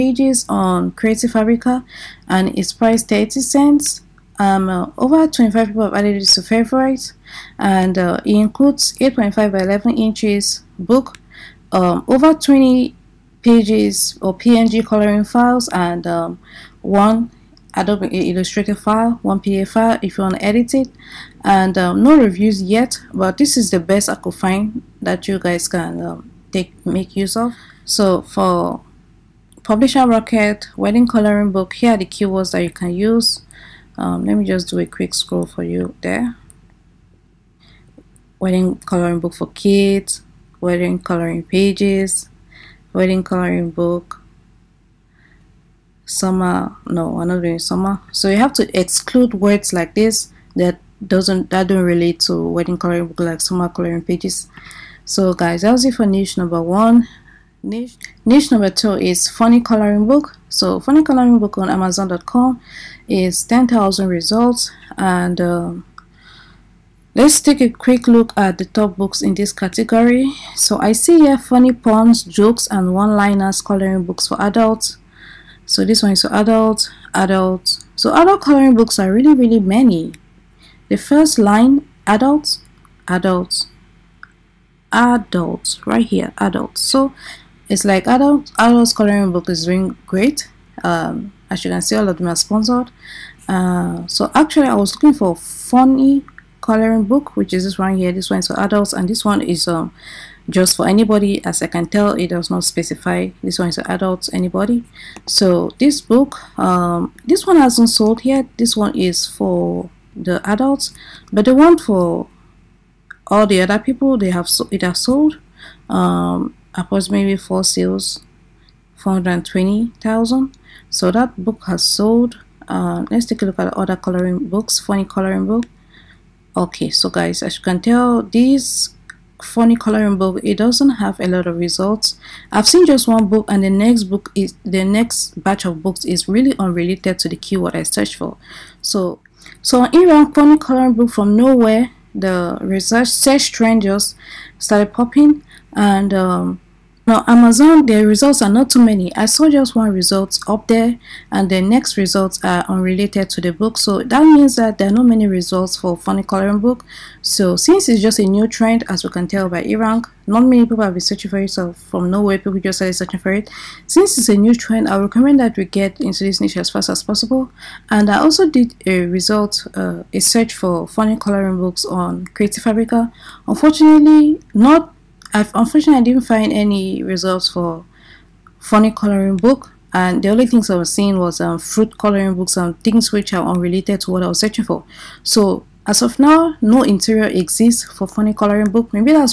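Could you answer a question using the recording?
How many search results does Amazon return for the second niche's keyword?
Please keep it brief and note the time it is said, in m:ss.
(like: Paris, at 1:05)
10,000, at 1:03.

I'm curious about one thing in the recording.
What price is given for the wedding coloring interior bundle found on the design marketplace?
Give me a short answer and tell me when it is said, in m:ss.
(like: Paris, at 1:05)
30 cents, at 0:03.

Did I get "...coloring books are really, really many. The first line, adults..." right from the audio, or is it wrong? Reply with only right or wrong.
right.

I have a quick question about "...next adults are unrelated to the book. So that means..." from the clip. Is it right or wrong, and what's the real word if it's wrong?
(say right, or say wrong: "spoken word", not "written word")
wrong: "results", not "adults".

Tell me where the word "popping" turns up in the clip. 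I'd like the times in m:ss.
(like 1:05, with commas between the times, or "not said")
2:24.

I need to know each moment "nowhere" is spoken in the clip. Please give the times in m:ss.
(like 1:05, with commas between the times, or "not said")
2:21, 2:42.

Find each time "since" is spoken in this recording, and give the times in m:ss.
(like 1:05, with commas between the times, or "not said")
2:37, 2:43.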